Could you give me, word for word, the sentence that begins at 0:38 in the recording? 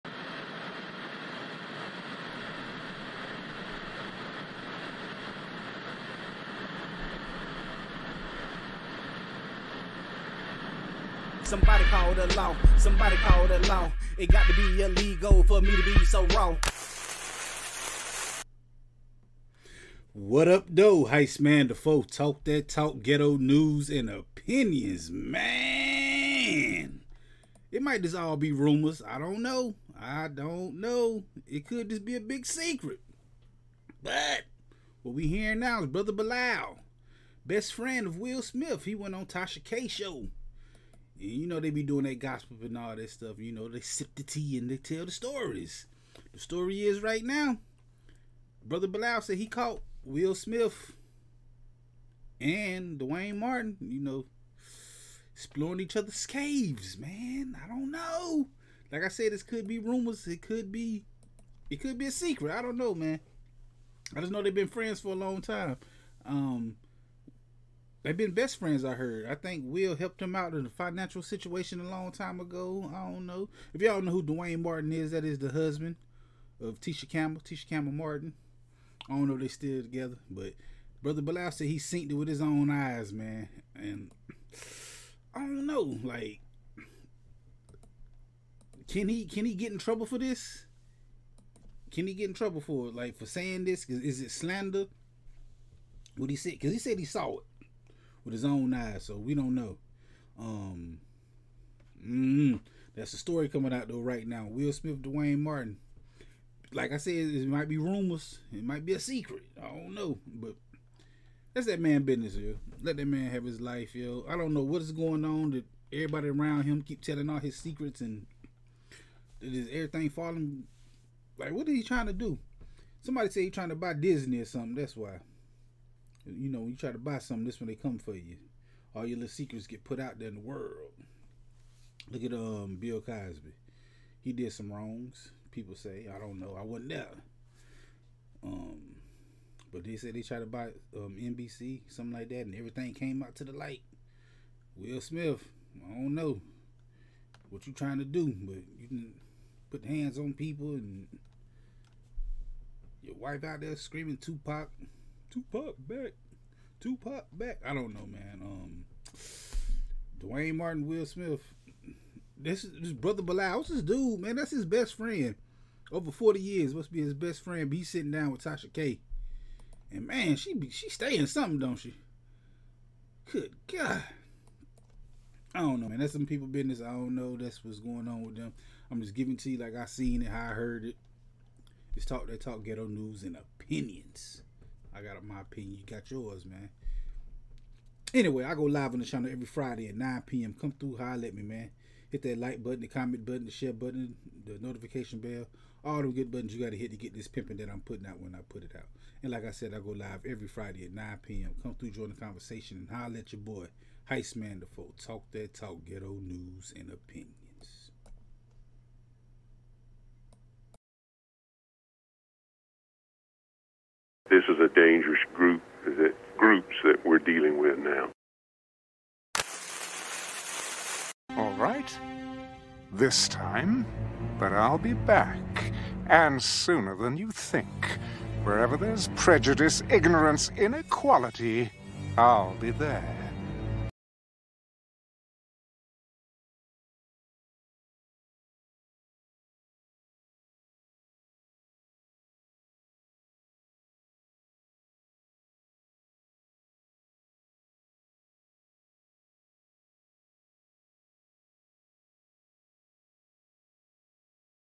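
He went on Tasha K show you know they be doing that gospel and all that stuff.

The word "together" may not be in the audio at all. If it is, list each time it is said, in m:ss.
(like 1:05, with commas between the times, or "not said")
1:19.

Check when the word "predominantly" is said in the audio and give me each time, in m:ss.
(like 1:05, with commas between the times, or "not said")
not said.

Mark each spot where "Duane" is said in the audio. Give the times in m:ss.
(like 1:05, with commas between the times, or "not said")
0:52, 1:14, 1:45, 2:40.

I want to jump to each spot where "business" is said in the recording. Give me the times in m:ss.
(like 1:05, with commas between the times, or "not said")
1:52, 2:56.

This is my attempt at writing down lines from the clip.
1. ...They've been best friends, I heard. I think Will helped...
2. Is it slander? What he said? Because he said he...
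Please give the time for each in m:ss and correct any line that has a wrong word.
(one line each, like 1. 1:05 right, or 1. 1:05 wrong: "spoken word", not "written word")
1. 1:08 right
2. 1:33 right.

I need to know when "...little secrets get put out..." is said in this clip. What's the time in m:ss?
2:09.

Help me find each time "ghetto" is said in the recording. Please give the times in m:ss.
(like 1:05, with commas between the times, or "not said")
0:23, 3:02, 3:25.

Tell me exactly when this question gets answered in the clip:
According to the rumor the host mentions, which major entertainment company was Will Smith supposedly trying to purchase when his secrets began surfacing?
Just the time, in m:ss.
2:03.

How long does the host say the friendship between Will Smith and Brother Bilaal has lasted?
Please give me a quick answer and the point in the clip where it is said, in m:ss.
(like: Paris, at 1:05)
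Over 40 years, at 2:45.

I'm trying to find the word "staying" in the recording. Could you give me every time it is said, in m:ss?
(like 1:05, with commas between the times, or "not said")
2:50.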